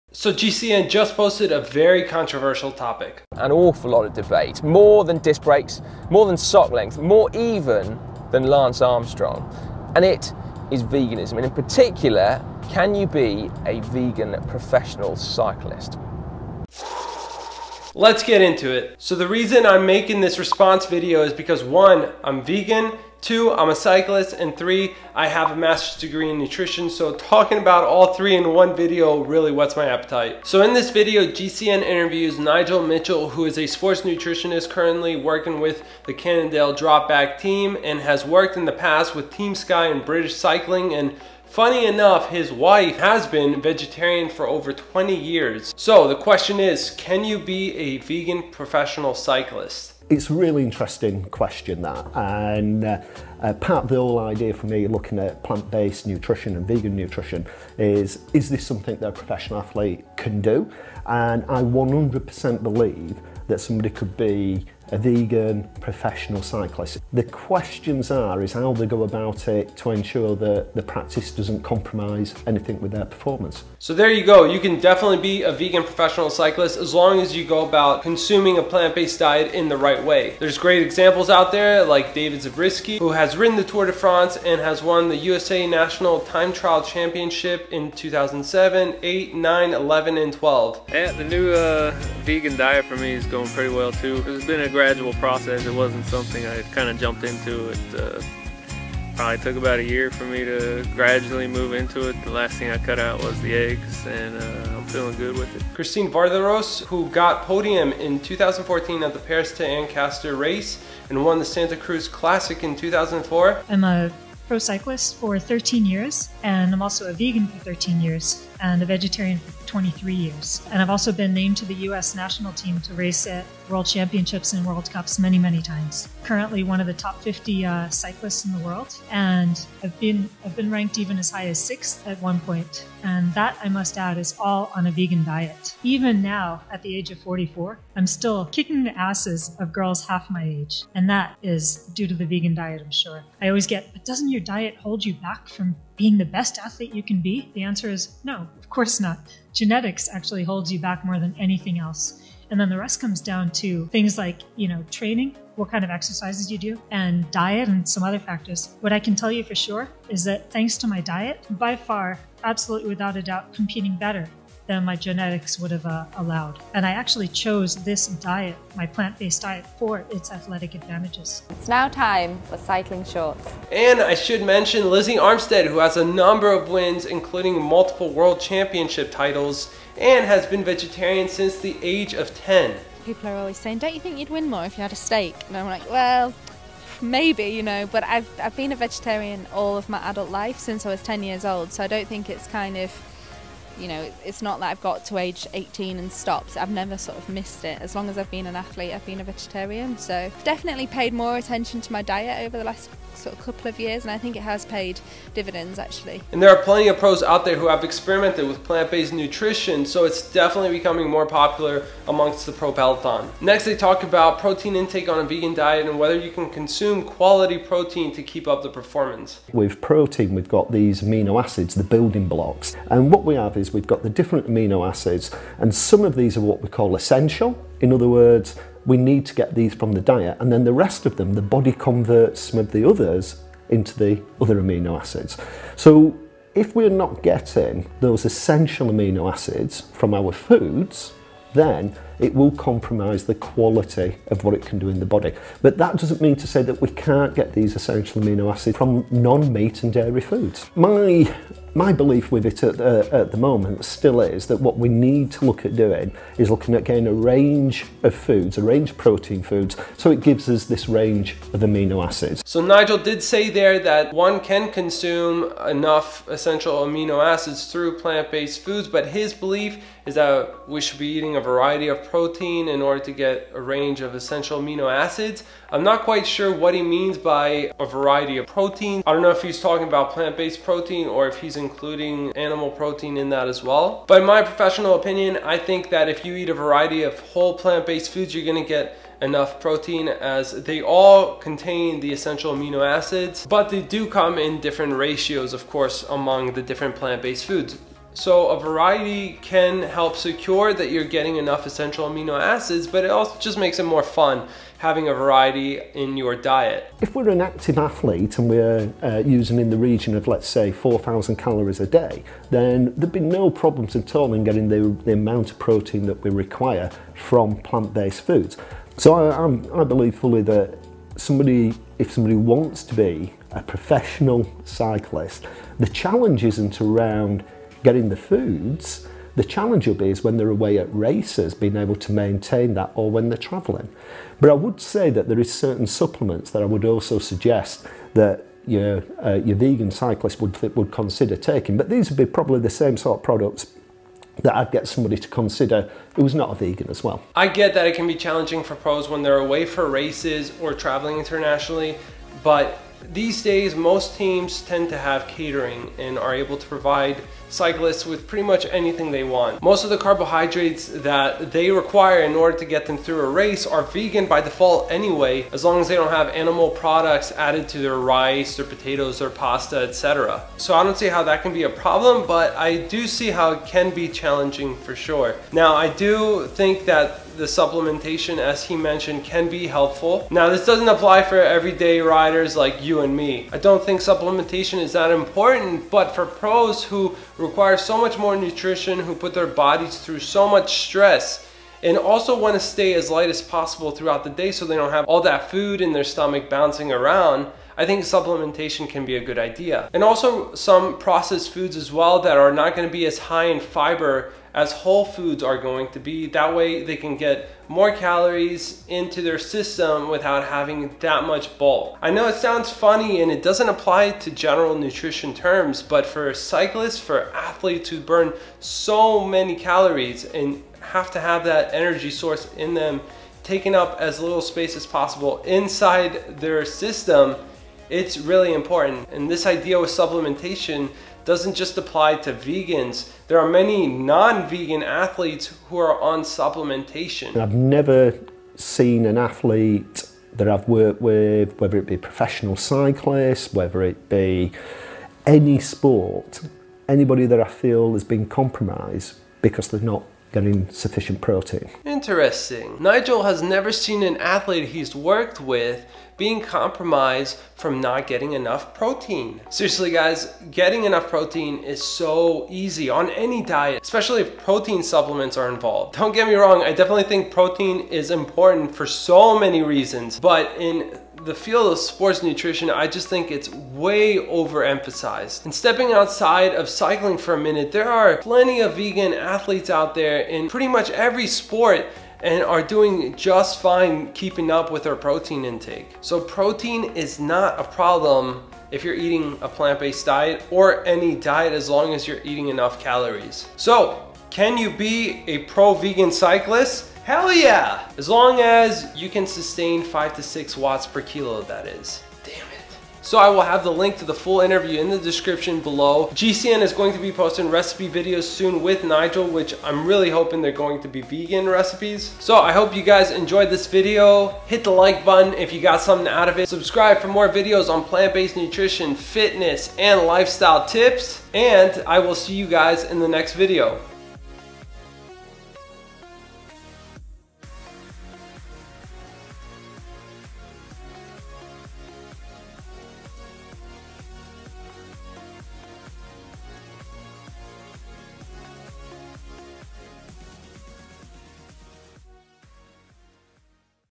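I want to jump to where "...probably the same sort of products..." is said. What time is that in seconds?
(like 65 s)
342 s.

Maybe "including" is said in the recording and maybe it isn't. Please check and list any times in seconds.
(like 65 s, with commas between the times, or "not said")
177 s, 281 s.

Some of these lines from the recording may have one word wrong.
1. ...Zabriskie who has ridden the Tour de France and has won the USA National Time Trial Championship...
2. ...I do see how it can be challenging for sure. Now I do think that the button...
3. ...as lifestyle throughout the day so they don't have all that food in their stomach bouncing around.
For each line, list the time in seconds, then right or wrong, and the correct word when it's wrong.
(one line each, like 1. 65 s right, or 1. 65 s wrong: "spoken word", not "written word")
1. 82 s right
2. 372 s wrong: "supplementation", not "button"
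3. 393 s wrong: "possible", not "lifestyle".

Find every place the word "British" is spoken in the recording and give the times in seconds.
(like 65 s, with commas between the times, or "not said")
40 s.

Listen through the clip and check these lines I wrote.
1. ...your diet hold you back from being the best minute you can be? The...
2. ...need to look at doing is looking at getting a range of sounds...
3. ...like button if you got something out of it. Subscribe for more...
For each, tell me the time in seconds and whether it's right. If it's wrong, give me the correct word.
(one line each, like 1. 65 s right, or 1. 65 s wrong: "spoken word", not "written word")
1. 144 s wrong: "athlete", not "minute"
2. 254 s wrong: "foods", not "sounds"
3. 514 s right.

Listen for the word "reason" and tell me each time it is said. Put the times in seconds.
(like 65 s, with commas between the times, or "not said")
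19 s, 469 s.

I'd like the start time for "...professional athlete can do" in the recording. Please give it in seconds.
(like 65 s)
59 s.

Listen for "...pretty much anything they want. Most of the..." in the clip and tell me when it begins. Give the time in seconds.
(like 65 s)
358 s.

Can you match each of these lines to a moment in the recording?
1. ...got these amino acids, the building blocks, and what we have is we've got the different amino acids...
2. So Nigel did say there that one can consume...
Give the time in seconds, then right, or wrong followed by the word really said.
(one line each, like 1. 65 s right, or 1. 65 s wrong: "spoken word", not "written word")
1. 220 s right
2. 262 s right.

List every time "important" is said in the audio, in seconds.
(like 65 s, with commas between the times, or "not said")
385 s, 428 s, 468 s.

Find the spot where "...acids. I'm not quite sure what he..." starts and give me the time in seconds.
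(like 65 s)
275 s.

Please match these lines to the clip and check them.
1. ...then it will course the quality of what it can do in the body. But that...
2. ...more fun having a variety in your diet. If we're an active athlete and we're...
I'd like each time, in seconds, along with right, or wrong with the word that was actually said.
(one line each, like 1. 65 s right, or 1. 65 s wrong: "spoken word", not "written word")
1. 241 s wrong: "compromise", not "course"
2. 303 s right.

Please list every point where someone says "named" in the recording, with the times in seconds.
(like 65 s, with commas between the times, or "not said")
121 s.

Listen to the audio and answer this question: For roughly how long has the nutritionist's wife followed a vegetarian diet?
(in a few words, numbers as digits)
over 20 years.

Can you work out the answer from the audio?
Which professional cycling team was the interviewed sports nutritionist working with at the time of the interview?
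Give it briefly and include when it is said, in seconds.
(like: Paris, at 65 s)
Cannondale Drapac, at 36 s.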